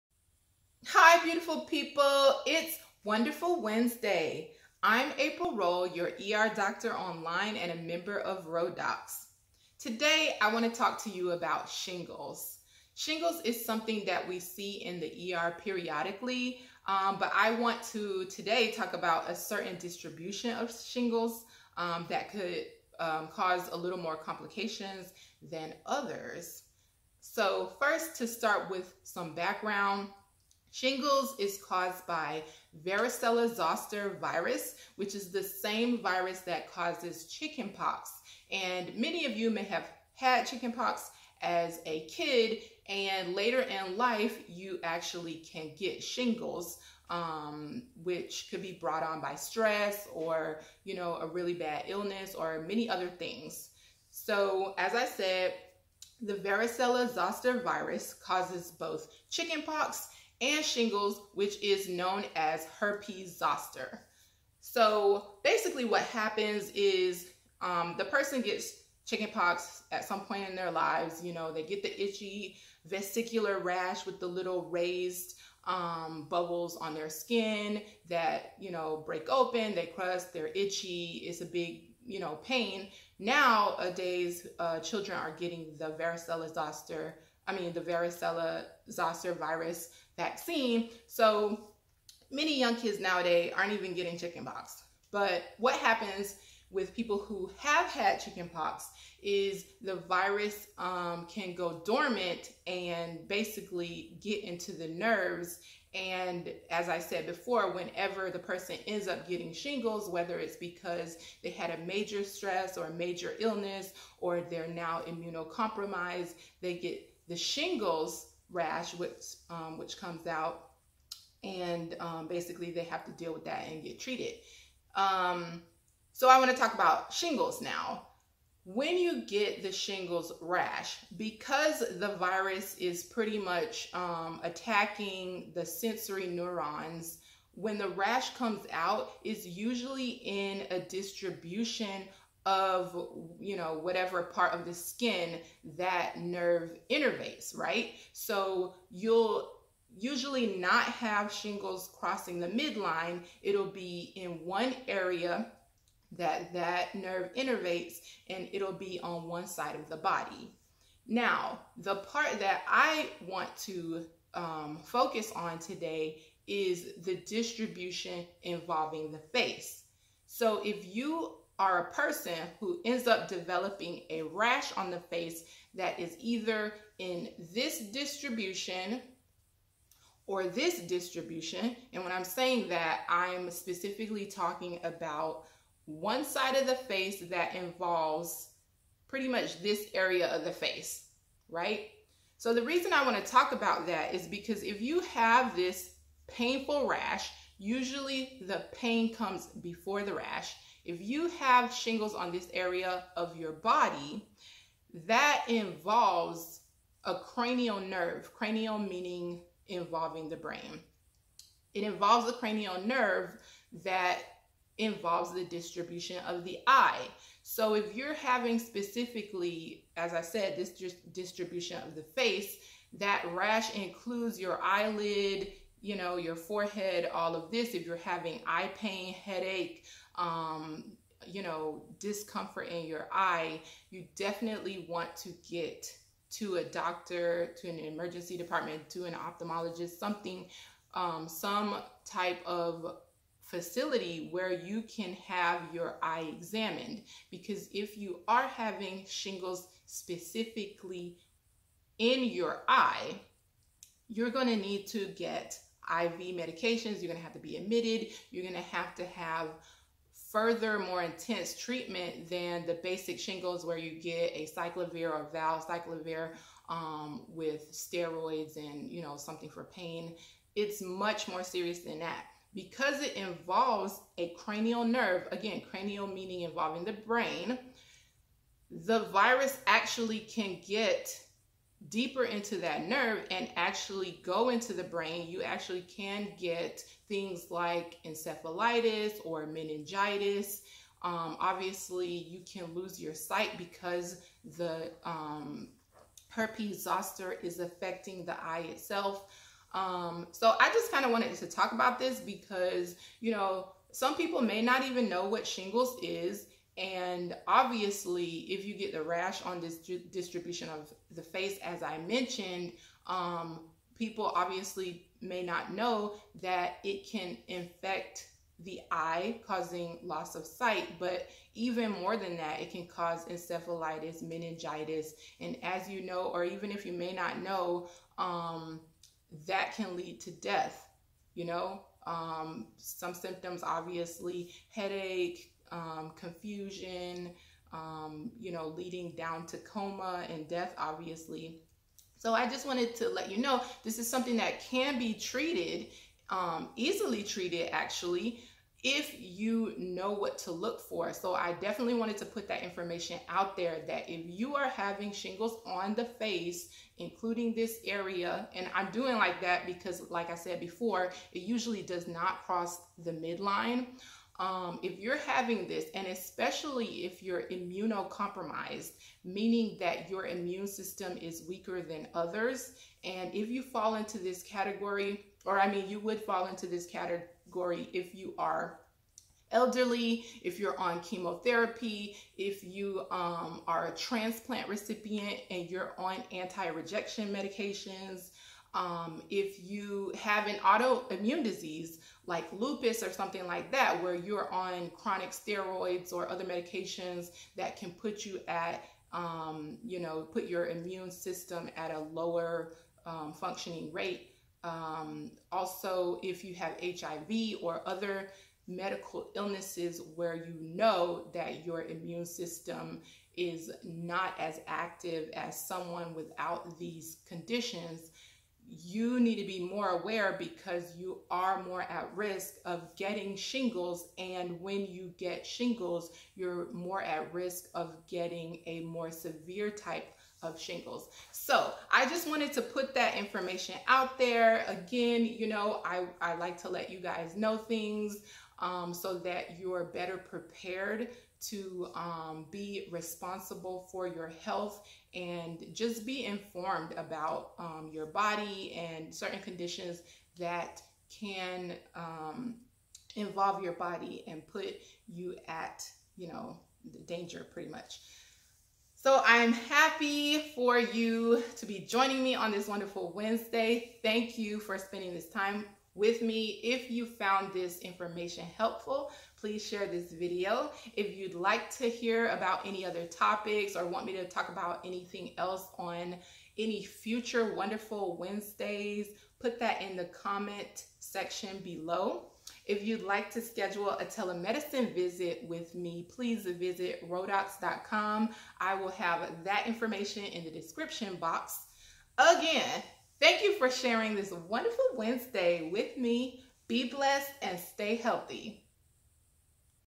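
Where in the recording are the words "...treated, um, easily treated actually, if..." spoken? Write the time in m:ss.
5:45.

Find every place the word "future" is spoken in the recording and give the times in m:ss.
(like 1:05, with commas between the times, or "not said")
7:56.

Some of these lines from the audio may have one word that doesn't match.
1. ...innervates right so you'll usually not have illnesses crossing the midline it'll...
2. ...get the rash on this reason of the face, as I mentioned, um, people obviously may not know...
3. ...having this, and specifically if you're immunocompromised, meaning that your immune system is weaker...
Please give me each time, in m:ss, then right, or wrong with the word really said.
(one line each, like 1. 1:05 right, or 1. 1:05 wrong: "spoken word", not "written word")
1. 2:26 wrong: "shingles", not "illnesses"
2. 5:08 wrong: "distribution", not "reason"
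3. 6:05 wrong: "especially", not "specifically".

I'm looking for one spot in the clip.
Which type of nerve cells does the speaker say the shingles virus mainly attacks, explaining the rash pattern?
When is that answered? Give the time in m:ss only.
2:15.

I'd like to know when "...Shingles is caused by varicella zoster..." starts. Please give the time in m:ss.
0:30.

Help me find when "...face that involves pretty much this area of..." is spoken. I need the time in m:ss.
3:06.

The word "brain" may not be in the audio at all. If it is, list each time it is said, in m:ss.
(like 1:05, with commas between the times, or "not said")
3:30, 4:36, 4:44.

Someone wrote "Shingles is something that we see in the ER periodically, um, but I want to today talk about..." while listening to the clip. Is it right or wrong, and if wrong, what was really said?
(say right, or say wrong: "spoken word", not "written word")
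right.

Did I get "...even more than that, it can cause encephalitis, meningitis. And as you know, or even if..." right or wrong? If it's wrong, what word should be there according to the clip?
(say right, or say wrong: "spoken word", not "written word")
right.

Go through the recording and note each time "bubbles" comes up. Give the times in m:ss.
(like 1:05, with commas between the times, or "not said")
1:16.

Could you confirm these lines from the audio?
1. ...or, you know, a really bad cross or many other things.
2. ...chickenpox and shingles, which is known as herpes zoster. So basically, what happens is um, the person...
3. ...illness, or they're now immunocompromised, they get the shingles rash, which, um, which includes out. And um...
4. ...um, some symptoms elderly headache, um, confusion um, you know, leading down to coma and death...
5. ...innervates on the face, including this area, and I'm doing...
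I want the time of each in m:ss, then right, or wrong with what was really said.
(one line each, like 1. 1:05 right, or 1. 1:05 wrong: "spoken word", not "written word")
1. 0:50 wrong: "illness", not "cross"
2. 0:59 right
3. 1:53 wrong: "comes", not "includes"
4. 5:32 wrong: "obviously", not "elderly"
5. 5:55 wrong: "shingles", not "innervates".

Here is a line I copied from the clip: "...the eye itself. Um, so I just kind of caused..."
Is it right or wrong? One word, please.
wrong.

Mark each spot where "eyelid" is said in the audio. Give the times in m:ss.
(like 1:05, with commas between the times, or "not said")
3:44.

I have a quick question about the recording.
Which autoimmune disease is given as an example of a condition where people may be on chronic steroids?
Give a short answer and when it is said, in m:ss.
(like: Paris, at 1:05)
lupus, at 6:32.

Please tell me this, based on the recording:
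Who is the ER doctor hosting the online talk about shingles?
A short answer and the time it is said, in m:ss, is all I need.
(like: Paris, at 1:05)
April Rolle, at 0:05.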